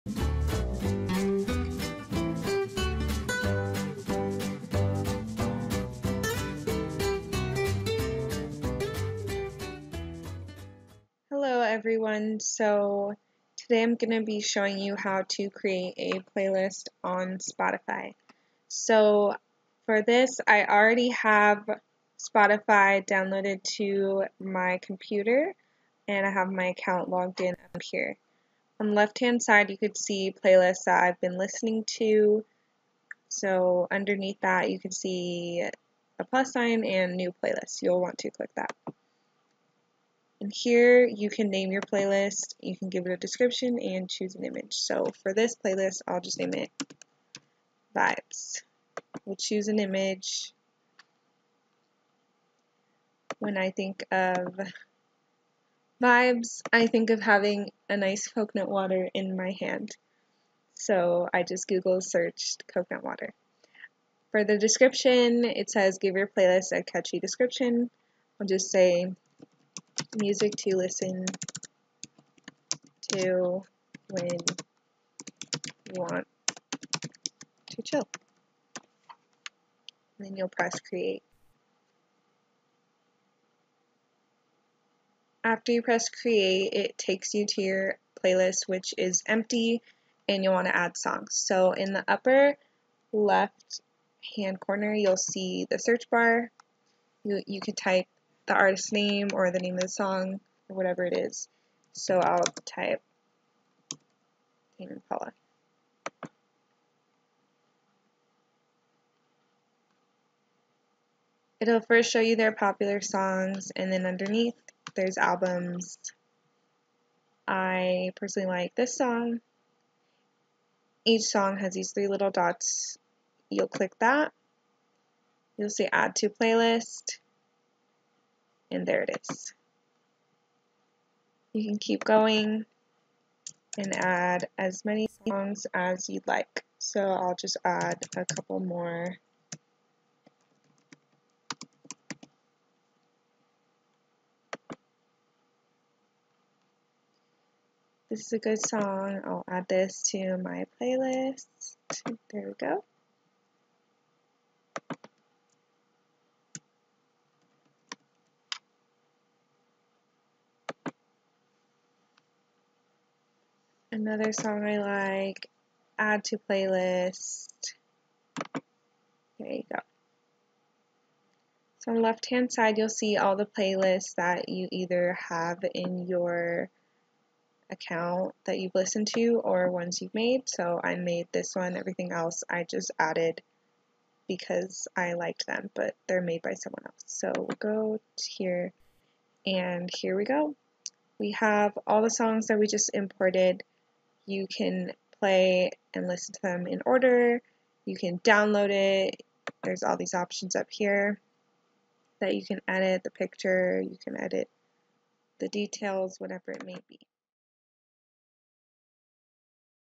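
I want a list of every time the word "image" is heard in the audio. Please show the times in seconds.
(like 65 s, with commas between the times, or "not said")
44 s, 49 s.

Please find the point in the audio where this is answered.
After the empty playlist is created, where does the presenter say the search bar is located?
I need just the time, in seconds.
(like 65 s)
92 s.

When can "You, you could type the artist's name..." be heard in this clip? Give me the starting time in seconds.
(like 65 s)
97 s.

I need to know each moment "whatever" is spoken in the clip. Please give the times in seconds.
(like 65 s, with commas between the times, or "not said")
100 s, 206 s.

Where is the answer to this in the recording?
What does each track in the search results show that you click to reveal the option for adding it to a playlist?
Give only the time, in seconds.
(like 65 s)
121 s.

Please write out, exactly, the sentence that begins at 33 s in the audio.
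So underneath that, you can see a plus sign and new playlist.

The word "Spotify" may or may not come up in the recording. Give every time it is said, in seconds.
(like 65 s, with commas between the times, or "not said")
17 s, 22 s.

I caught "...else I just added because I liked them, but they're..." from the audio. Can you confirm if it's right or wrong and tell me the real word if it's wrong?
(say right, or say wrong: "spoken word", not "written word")
right.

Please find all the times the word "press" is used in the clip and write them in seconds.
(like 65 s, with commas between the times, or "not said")
80 s, 85 s.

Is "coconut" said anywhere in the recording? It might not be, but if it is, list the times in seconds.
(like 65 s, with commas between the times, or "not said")
58 s, 62 s.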